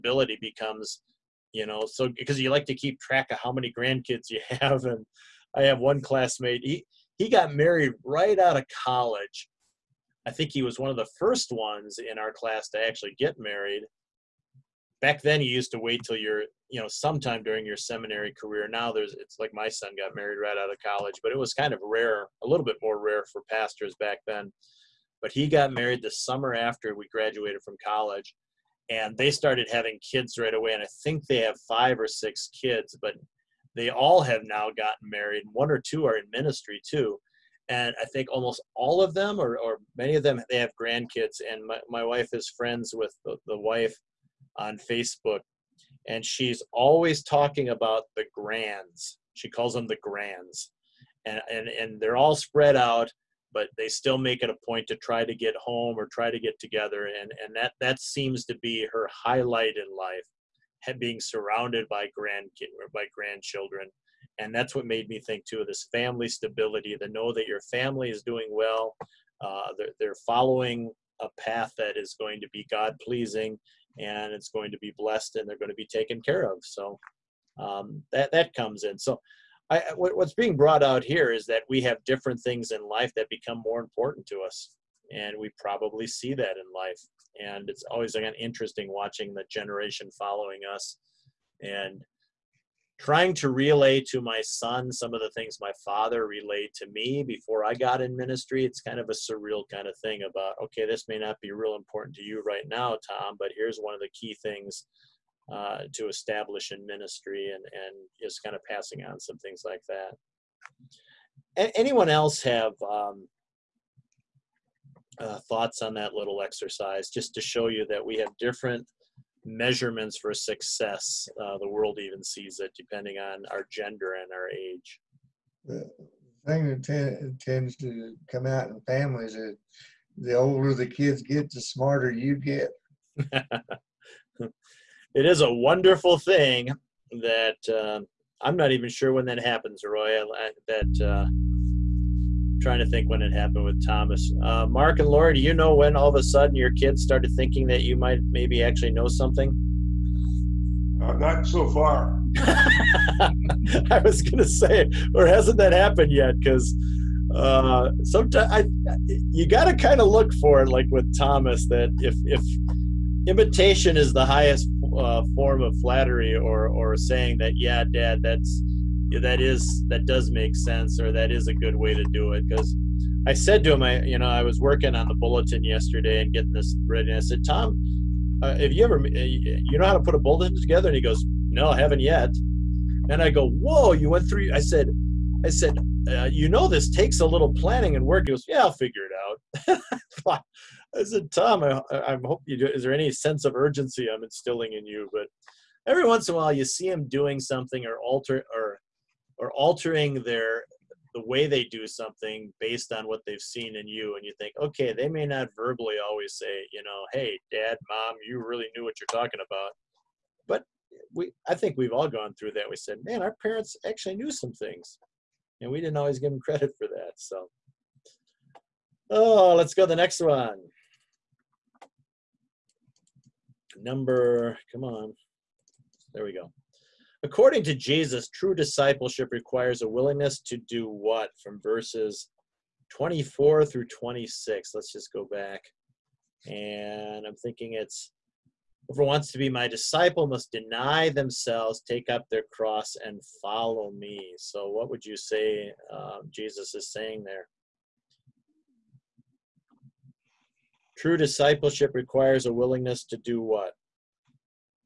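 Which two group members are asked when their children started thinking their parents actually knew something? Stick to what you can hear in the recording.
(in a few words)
Mark and Laura.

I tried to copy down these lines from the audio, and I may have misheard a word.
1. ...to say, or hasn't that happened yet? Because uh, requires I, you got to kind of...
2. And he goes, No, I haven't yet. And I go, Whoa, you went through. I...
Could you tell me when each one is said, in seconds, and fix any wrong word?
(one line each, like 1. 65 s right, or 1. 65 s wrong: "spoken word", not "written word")
1. 154 s wrong: "sometimes", not "requires"
2. 180 s right.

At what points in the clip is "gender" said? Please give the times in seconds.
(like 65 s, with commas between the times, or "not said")
123 s.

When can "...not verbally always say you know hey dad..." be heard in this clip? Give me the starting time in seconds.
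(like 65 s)
205 s.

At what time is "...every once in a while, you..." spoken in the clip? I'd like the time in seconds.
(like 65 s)
195 s.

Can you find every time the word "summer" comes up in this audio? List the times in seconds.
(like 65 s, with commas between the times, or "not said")
26 s.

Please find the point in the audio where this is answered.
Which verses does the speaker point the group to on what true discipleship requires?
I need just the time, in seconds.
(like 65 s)
232 s.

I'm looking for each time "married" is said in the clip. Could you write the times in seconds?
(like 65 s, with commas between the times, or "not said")
7 s, 13 s, 20 s, 25 s, 35 s.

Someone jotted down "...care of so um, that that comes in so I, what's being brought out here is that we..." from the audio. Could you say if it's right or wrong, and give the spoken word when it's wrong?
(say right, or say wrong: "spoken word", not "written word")
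right.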